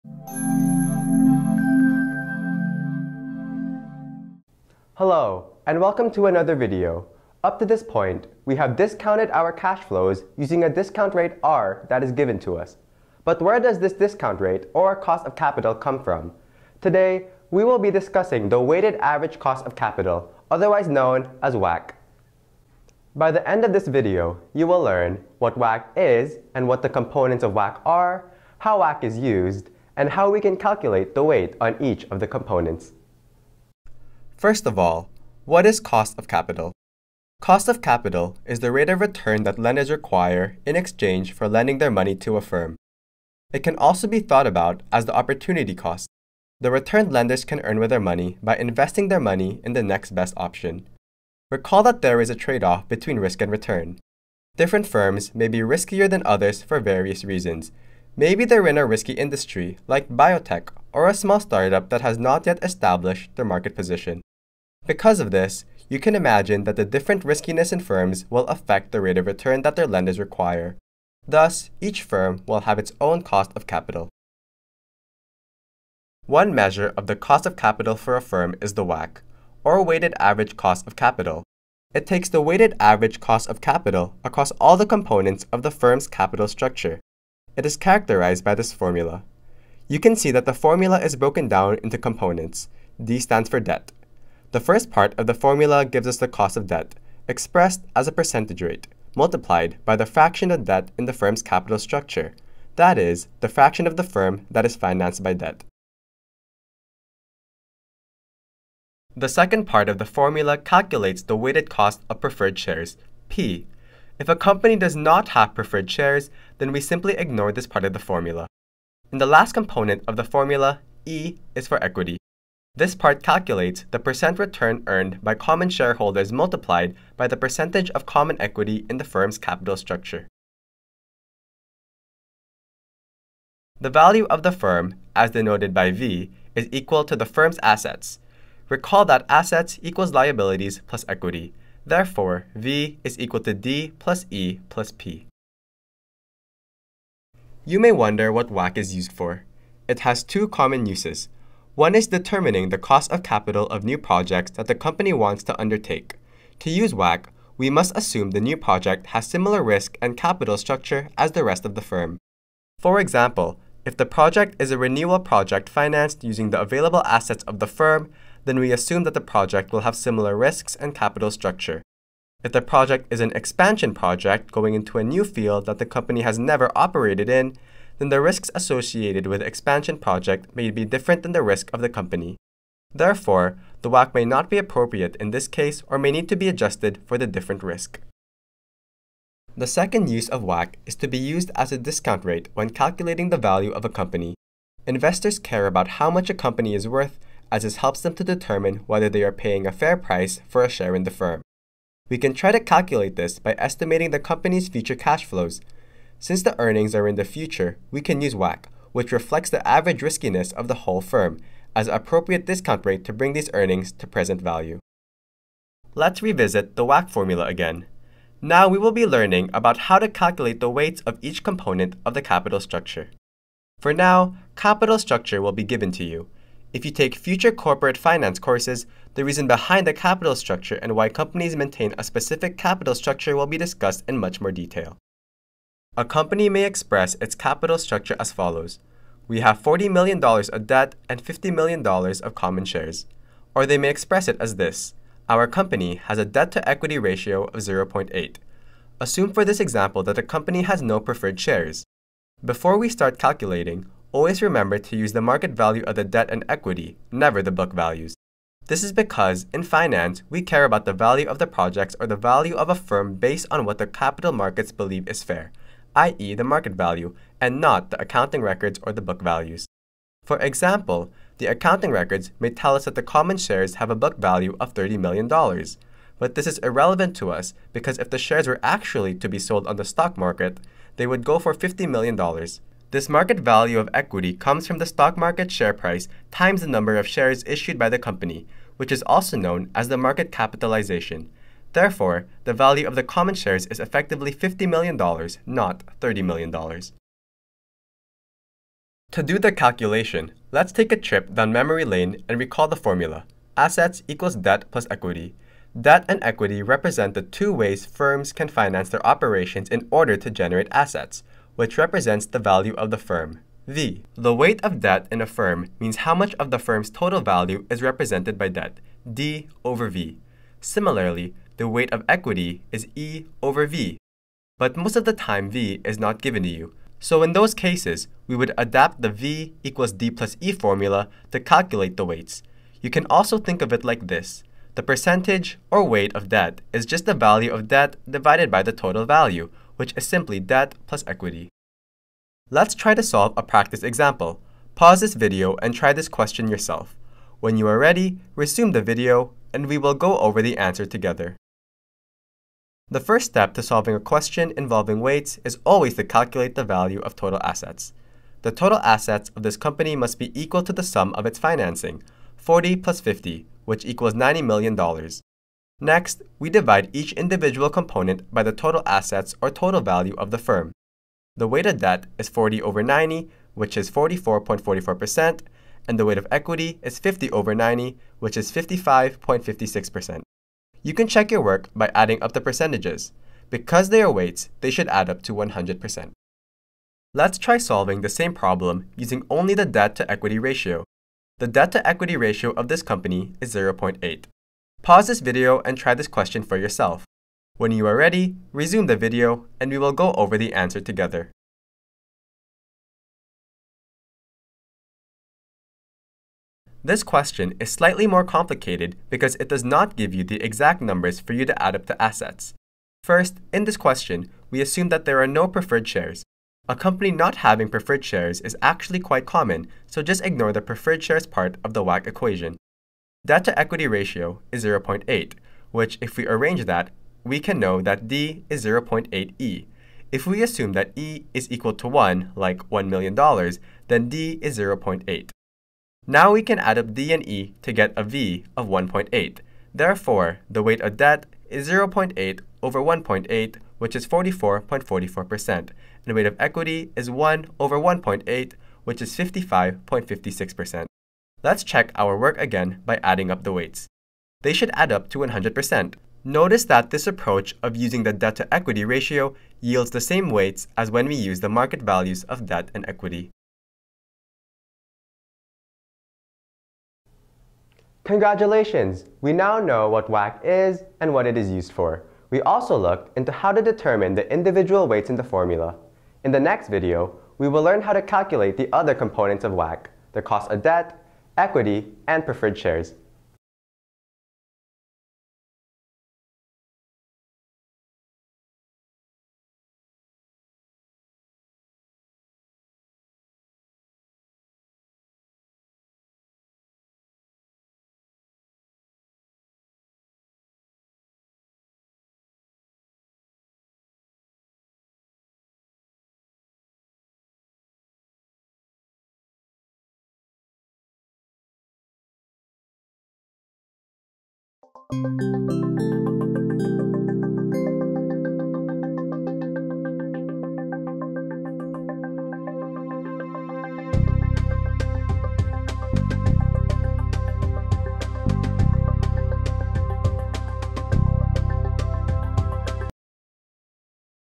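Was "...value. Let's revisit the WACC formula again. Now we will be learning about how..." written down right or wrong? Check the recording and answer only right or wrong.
right.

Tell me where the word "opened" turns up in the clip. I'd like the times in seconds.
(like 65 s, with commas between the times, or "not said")
not said.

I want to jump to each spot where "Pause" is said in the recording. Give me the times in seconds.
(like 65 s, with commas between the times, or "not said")
344 s, 394 s.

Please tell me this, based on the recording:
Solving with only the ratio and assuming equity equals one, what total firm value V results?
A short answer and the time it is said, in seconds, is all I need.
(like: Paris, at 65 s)
1.8, at 437 s.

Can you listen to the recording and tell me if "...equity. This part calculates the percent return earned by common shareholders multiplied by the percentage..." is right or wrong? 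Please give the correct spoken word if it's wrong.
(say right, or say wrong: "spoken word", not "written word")
right.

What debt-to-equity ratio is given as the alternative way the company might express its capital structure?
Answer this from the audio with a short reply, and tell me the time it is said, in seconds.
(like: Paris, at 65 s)
0.8, at 247 s.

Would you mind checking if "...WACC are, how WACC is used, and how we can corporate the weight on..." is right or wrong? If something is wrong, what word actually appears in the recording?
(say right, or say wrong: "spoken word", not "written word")
wrong: "calculate", not "corporate".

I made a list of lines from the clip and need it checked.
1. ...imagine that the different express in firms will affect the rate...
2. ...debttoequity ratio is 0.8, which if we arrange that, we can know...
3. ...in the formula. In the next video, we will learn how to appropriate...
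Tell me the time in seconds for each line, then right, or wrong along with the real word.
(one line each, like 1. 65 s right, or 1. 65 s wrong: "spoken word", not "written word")
1. 66 s wrong: "riskiness", not "express"
2. 423 s wrong: "equity", not "debttoequity"
3. 475 s wrong: "calculate", not "appropriate".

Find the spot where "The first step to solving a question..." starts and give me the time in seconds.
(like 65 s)
352 s.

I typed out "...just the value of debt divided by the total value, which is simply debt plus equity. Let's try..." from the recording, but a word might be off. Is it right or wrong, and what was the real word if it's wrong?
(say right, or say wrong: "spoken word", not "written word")
right.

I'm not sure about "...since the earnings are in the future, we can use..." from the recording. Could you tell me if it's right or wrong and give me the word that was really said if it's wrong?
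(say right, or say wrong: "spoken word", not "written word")
right.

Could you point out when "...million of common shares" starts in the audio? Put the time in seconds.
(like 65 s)
241 s.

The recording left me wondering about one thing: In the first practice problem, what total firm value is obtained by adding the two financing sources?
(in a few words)
$90 million.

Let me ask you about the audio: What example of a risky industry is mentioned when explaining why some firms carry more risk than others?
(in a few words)
biotech.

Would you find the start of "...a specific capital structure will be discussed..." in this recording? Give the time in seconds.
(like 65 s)
231 s.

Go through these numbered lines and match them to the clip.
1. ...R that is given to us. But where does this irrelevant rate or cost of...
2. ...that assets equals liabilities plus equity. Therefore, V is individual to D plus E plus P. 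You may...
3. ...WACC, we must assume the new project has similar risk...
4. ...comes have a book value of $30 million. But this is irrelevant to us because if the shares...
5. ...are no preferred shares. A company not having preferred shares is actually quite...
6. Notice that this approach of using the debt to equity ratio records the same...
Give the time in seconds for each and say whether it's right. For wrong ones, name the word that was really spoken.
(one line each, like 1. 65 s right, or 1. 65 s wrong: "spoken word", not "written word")
1. 11 s wrong: "discount", not "irrelevant"
2. 139 s wrong: "equal", not "individual"
3. 156 s right
4. 273 s wrong: "shares", not "comes"
5. 415 s right
6. 456 s wrong: "yields", not "records".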